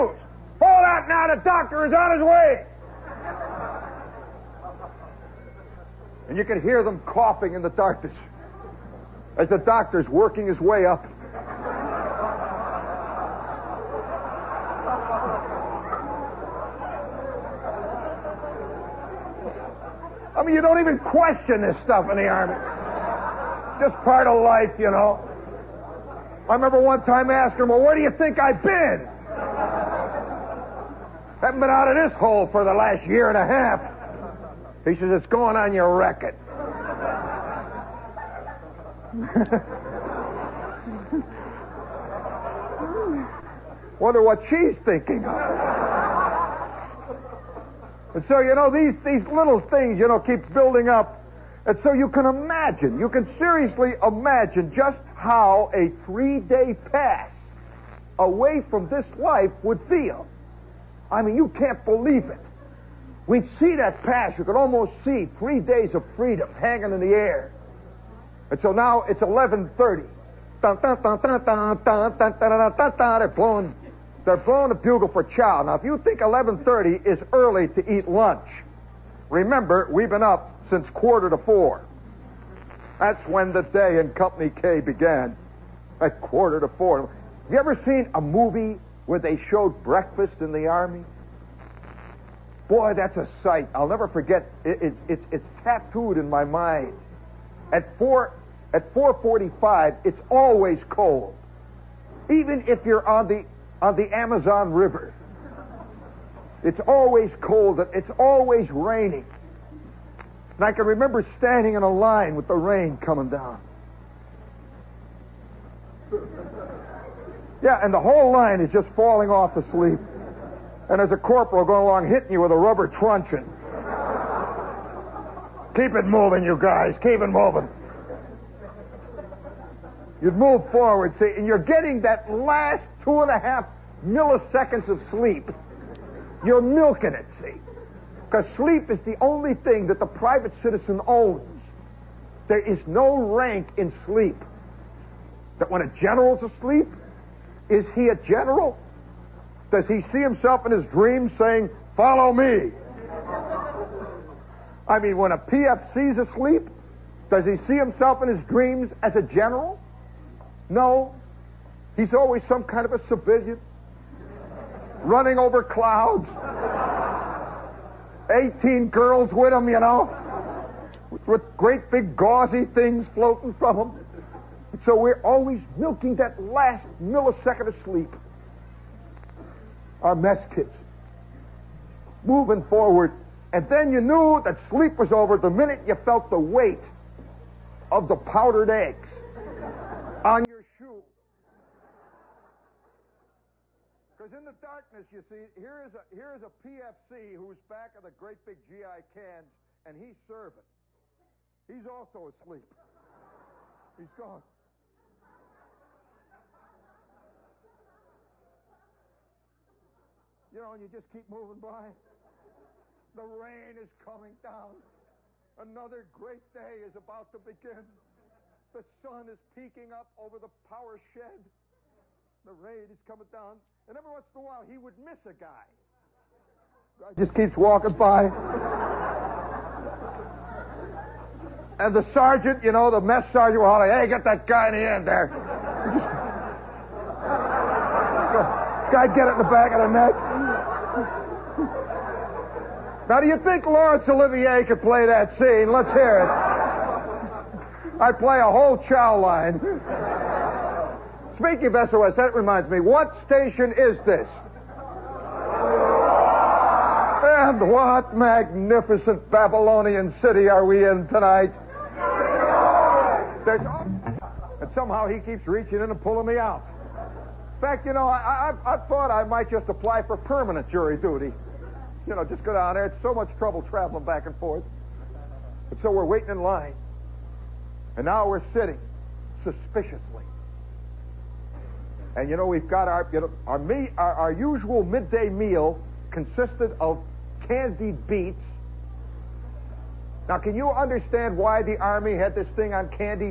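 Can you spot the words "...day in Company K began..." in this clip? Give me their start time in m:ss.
1:23.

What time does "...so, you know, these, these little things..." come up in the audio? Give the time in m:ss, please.
0:48.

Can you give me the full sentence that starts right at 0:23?
Just part of life, you know.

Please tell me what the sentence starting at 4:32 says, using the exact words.
You know, just go down there.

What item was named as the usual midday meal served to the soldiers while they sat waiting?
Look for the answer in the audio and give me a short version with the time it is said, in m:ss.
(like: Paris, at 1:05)
candied beets, at 4:47.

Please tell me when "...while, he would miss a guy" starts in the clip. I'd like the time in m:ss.
3:44.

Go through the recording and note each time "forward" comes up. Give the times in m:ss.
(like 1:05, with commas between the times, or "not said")
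2:10, 3:02.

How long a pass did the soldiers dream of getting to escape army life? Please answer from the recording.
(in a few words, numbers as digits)
three days.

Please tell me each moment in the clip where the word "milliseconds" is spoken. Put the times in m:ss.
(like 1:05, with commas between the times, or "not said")
2:14, 2:57.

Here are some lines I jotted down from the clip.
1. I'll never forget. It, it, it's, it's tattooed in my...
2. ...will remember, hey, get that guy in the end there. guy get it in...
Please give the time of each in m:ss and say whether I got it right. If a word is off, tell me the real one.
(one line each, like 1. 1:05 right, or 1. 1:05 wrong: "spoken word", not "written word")
1. 1:33 right
2. 3:53 wrong: "holler", not "remember".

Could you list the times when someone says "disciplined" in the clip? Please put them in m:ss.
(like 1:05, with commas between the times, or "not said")
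not said.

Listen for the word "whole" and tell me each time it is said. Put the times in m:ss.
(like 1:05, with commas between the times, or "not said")
1:57, 4:08.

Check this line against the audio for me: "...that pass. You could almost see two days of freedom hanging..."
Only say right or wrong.
wrong.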